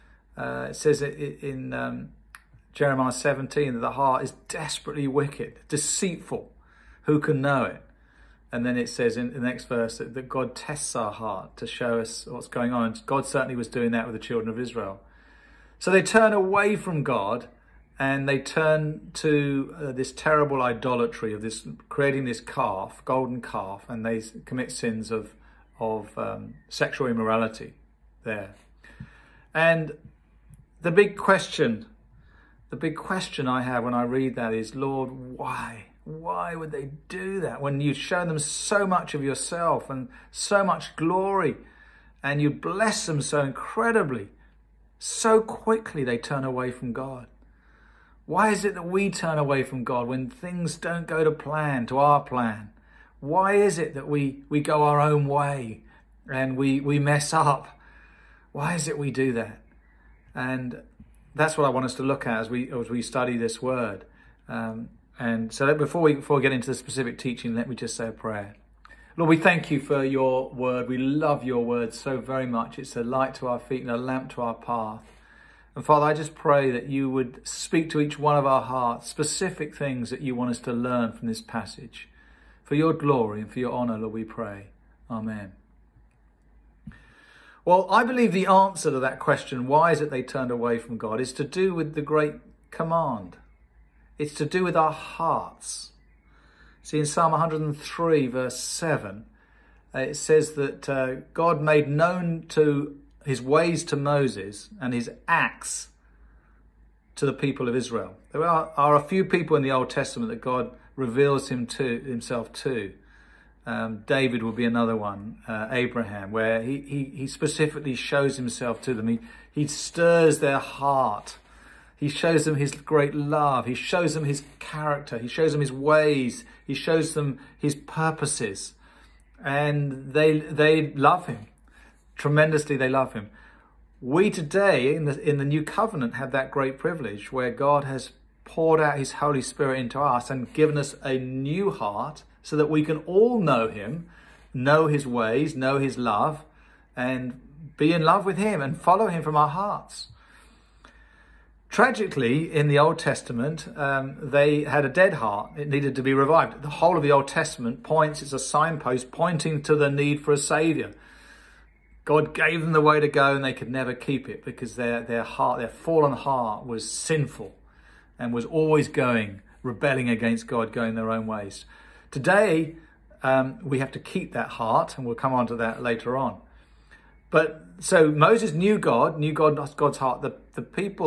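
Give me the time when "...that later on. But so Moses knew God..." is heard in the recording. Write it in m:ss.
2:55.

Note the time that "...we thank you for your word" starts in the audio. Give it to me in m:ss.
1:09.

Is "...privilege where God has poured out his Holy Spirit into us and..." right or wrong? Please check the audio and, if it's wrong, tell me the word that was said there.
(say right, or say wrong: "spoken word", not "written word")
right.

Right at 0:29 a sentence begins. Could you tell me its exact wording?
And the big question, the big question I have when I read that is, Lord, why?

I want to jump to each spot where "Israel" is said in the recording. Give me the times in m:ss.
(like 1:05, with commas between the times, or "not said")
0:14, 1:47.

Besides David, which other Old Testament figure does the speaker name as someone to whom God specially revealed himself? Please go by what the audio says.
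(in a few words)
Abraham.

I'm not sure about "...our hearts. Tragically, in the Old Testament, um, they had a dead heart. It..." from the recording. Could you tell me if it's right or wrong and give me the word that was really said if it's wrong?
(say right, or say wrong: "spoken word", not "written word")
right.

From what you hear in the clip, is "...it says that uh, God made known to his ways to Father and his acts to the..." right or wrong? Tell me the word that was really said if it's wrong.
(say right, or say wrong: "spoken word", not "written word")
wrong: "Moses", not "Father".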